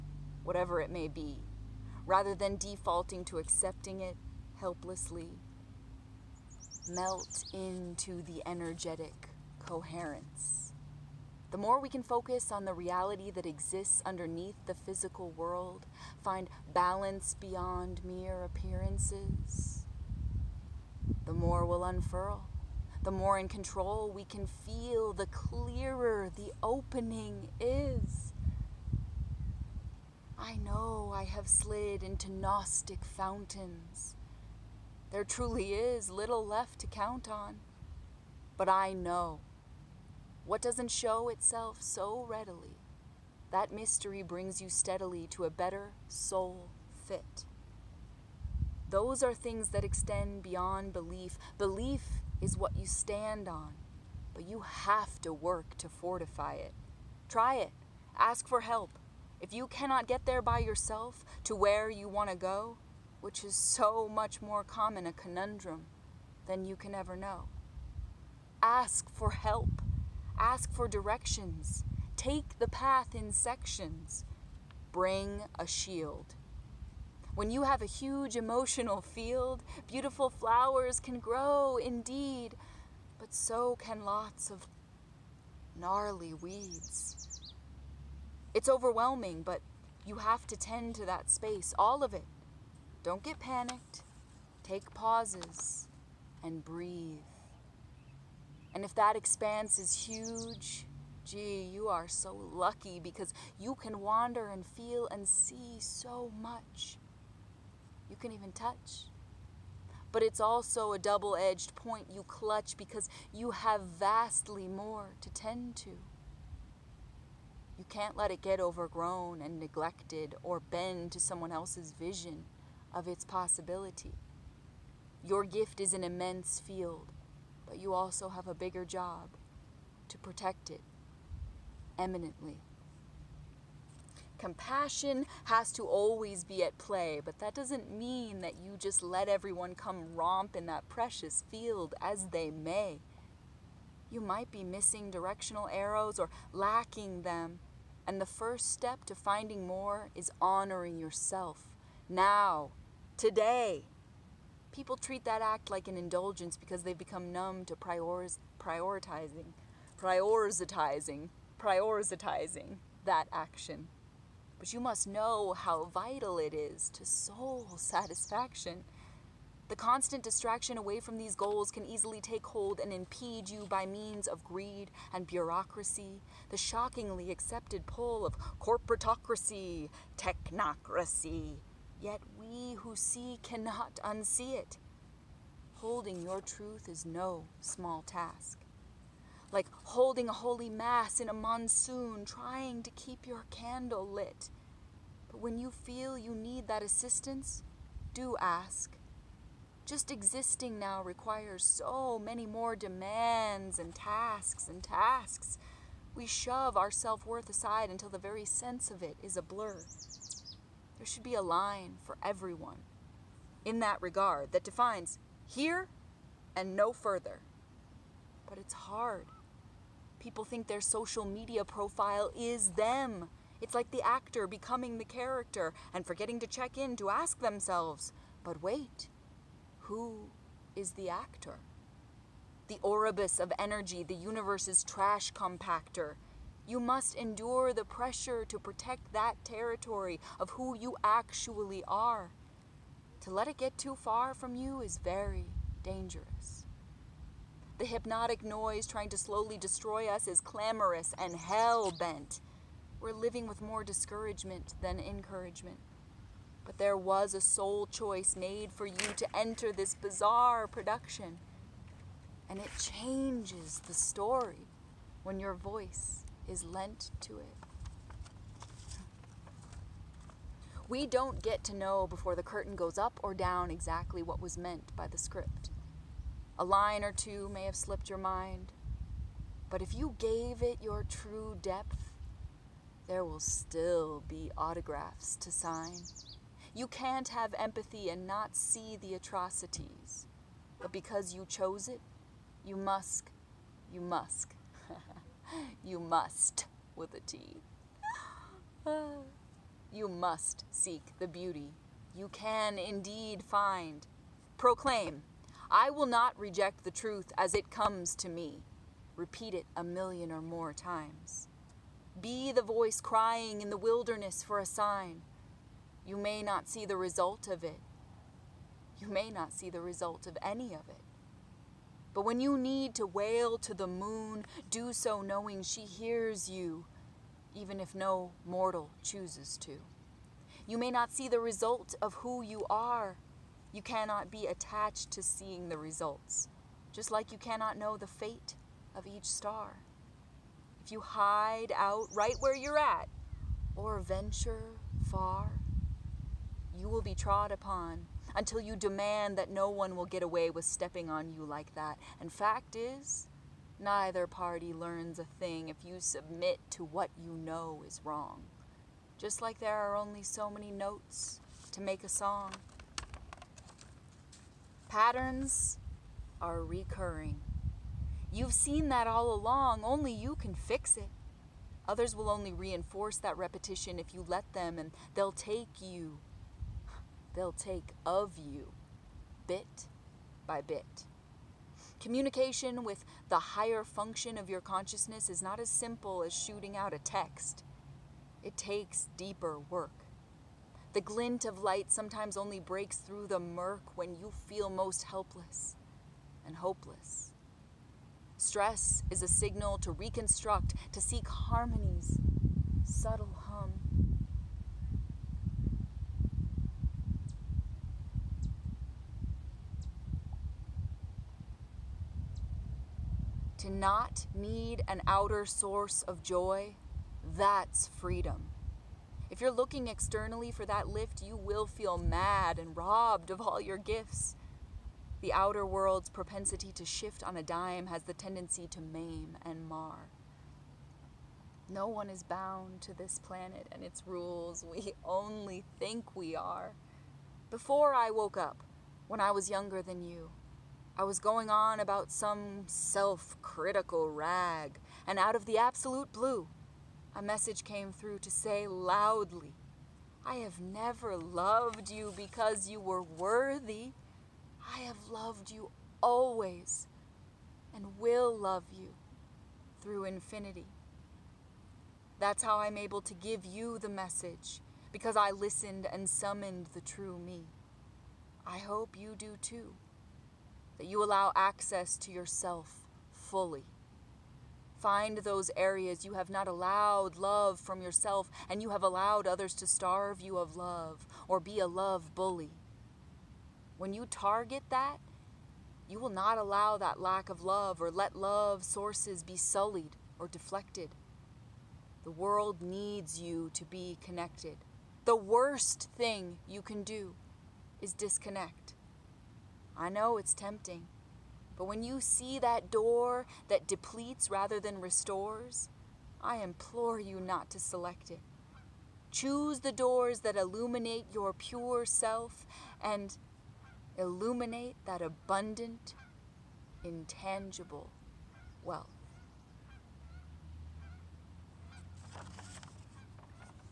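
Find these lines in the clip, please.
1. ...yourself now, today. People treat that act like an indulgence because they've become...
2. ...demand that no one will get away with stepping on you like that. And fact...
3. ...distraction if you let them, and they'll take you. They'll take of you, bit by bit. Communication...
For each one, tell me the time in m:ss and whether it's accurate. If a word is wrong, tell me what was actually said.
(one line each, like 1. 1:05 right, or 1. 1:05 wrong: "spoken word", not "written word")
1. 2:30 right
2. 5:48 right
3. 6:13 wrong: "repetition", not "distraction".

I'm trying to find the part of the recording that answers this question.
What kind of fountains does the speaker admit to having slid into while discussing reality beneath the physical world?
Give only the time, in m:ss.
0:32.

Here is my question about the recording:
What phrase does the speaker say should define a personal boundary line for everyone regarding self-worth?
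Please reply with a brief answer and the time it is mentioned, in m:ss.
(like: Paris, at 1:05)
Here and no further, at 3:35.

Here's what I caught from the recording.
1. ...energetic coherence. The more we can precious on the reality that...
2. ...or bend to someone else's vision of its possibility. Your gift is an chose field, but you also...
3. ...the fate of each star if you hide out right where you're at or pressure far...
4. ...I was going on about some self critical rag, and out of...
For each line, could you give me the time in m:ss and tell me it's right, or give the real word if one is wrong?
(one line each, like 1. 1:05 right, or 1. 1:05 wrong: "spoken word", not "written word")
1. 0:08 wrong: "focus", not "precious"
2. 2:00 wrong: "immense", not "chose"
3. 5:37 wrong: "venture", not "pressure"
4. 7:20 right.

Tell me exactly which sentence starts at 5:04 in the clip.
Proclaim, I will not reject the truth as it comes to me.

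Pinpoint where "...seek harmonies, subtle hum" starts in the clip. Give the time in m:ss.
6:40.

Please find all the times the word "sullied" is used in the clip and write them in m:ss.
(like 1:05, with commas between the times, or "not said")
8:09.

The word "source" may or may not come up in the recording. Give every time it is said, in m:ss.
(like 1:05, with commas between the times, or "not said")
6:55, 8:08.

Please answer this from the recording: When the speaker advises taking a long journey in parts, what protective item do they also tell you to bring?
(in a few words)
A shield.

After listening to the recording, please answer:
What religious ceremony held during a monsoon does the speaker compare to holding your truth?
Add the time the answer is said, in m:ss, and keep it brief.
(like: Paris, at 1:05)
A holy mass, at 3:10.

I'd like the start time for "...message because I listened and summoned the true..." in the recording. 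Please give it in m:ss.
7:43.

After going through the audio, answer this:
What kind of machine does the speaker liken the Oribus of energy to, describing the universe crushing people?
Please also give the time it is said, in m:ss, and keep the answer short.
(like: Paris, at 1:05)
The universe's trash compactor, at 3:54.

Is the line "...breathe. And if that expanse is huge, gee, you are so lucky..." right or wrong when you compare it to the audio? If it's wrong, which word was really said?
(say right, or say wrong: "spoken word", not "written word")
right.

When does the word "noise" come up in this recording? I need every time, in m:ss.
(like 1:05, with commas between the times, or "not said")
4:08.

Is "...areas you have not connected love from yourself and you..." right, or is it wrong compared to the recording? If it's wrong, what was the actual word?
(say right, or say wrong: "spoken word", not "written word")
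wrong: "allowed", not "connected".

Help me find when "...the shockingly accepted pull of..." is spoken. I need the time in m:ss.
2:56.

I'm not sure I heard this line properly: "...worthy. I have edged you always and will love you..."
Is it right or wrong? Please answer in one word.
wrong.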